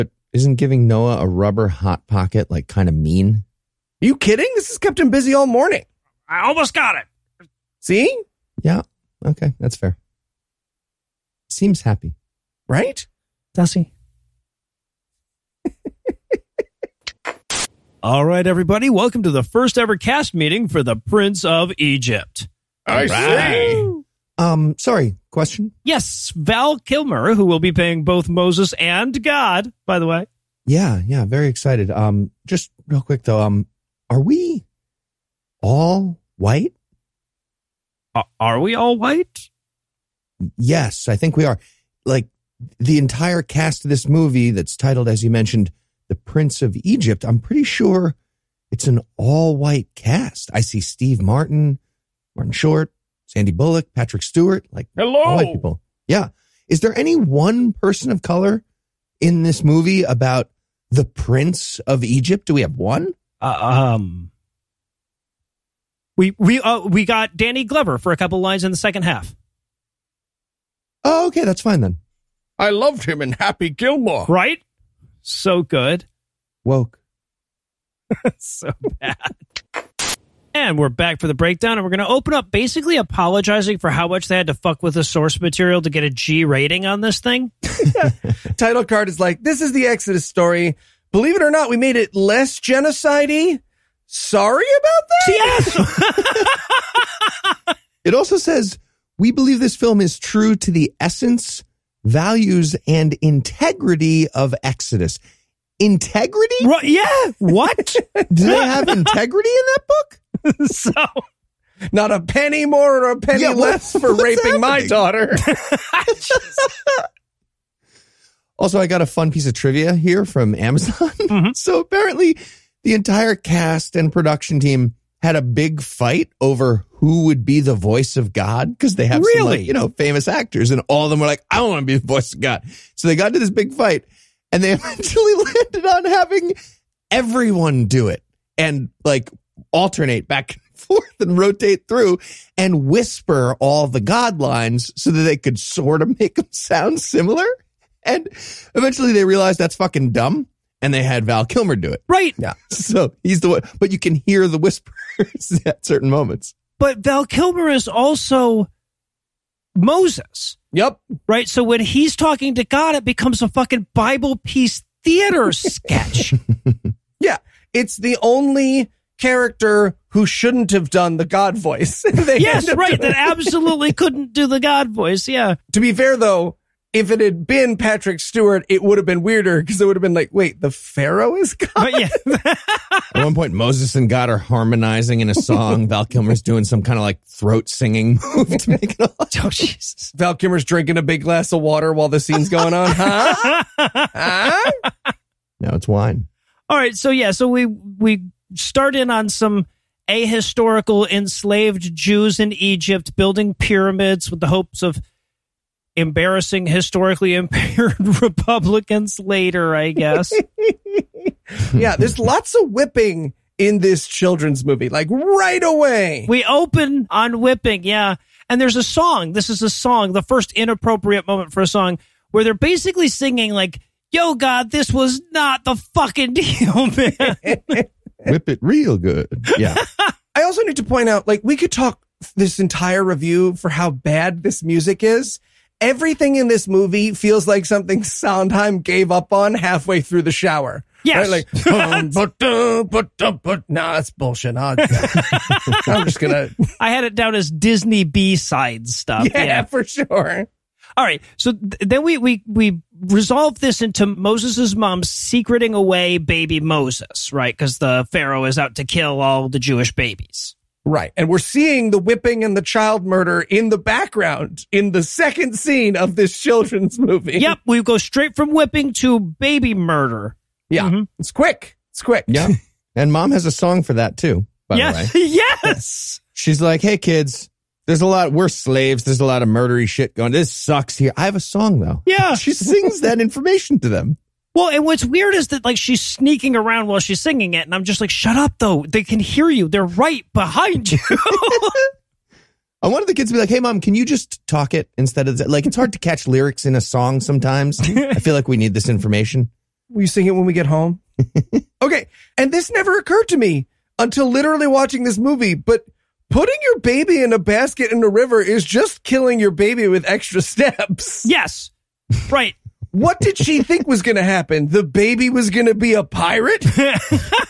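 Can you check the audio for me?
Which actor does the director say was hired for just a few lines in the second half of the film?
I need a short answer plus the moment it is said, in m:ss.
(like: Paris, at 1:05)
Danny Glover, at 1:07.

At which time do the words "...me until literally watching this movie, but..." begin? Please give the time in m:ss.
5:03.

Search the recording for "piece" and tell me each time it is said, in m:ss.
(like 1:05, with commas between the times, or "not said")
1:59, 2:44.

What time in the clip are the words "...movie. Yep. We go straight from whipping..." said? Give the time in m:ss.
4:26.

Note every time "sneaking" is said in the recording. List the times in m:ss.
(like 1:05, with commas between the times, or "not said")
4:45.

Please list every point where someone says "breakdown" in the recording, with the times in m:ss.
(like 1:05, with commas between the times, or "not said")
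1:21.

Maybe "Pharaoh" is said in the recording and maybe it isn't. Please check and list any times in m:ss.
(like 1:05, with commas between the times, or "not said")
3:00, 4:18.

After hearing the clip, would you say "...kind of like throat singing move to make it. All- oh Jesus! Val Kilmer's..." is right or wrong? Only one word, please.
right.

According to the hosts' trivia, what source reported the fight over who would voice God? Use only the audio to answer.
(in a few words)
Amazon.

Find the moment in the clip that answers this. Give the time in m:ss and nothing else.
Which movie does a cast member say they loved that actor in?
1:13.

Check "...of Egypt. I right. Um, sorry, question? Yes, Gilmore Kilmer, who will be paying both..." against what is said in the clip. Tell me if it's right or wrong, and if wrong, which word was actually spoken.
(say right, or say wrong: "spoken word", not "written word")
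wrong: "Val", not "Gilmore".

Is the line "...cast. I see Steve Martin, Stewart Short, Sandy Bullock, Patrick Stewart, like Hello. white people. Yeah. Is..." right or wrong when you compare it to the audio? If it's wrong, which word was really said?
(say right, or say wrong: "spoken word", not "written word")
wrong: "Martin", not "Stewart".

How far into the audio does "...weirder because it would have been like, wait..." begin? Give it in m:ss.
2:59.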